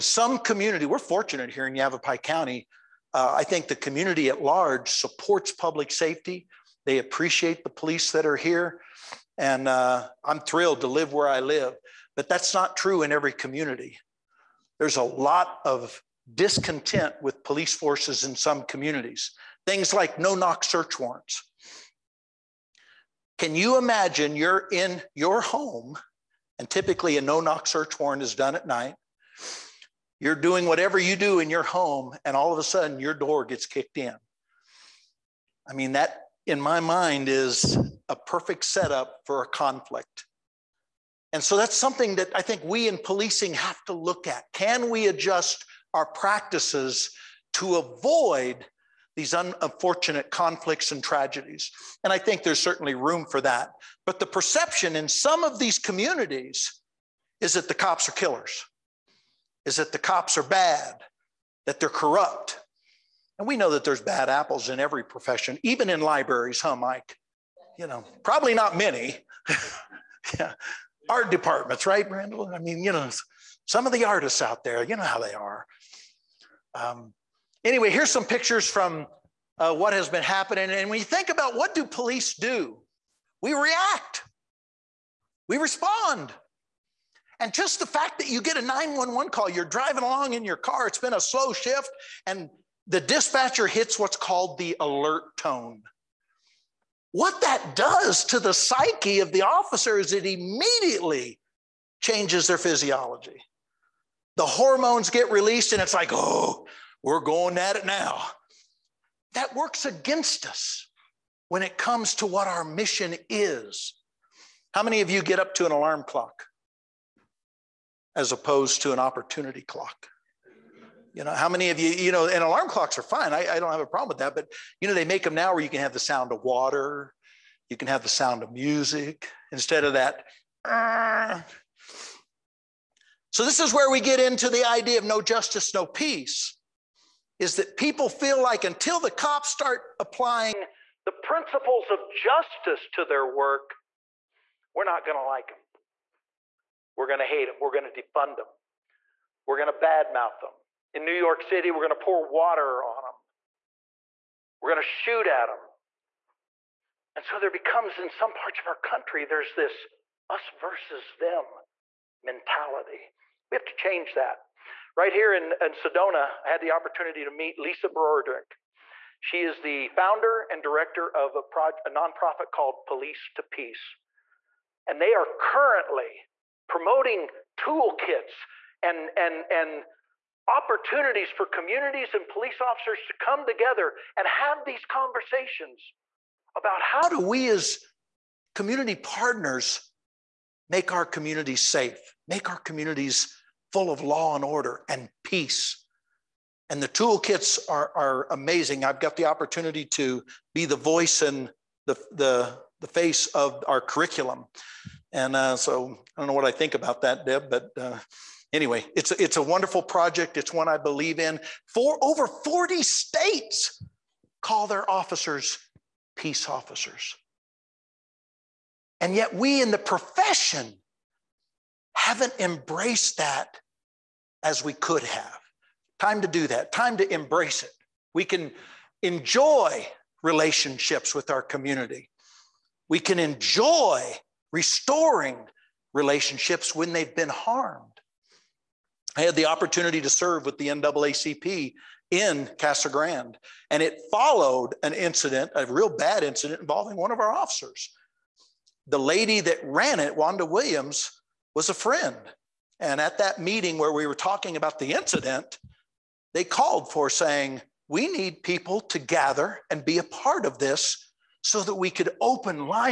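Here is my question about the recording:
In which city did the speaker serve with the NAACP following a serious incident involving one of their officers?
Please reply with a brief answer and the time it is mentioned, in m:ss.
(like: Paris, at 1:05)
Casa Grande, at 4:02.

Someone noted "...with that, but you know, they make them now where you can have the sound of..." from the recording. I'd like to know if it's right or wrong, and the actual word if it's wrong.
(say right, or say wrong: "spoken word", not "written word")
right.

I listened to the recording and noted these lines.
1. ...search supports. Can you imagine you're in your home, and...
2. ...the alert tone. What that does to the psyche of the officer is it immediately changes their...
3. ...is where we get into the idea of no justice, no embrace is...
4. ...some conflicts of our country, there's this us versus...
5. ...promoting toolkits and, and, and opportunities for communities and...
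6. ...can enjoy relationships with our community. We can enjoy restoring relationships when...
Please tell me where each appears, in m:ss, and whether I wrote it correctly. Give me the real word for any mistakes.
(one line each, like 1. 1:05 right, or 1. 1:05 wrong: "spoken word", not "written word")
1. 0:20 wrong: "warrants", not "supports"
2. 1:34 right
3. 2:13 wrong: "peace", not "embrace"
4. 2:38 wrong: "parts", not "conflicts"
5. 2:56 right
6. 3:48 right.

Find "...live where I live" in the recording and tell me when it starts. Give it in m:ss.
0:10.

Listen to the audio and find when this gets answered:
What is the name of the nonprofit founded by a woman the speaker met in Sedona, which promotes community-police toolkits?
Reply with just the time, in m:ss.
2:52.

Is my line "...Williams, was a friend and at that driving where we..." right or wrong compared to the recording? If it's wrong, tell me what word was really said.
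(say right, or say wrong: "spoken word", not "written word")
wrong: "meeting", not "driving".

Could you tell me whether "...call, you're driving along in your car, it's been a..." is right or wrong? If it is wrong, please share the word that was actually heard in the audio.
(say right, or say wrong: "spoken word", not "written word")
right.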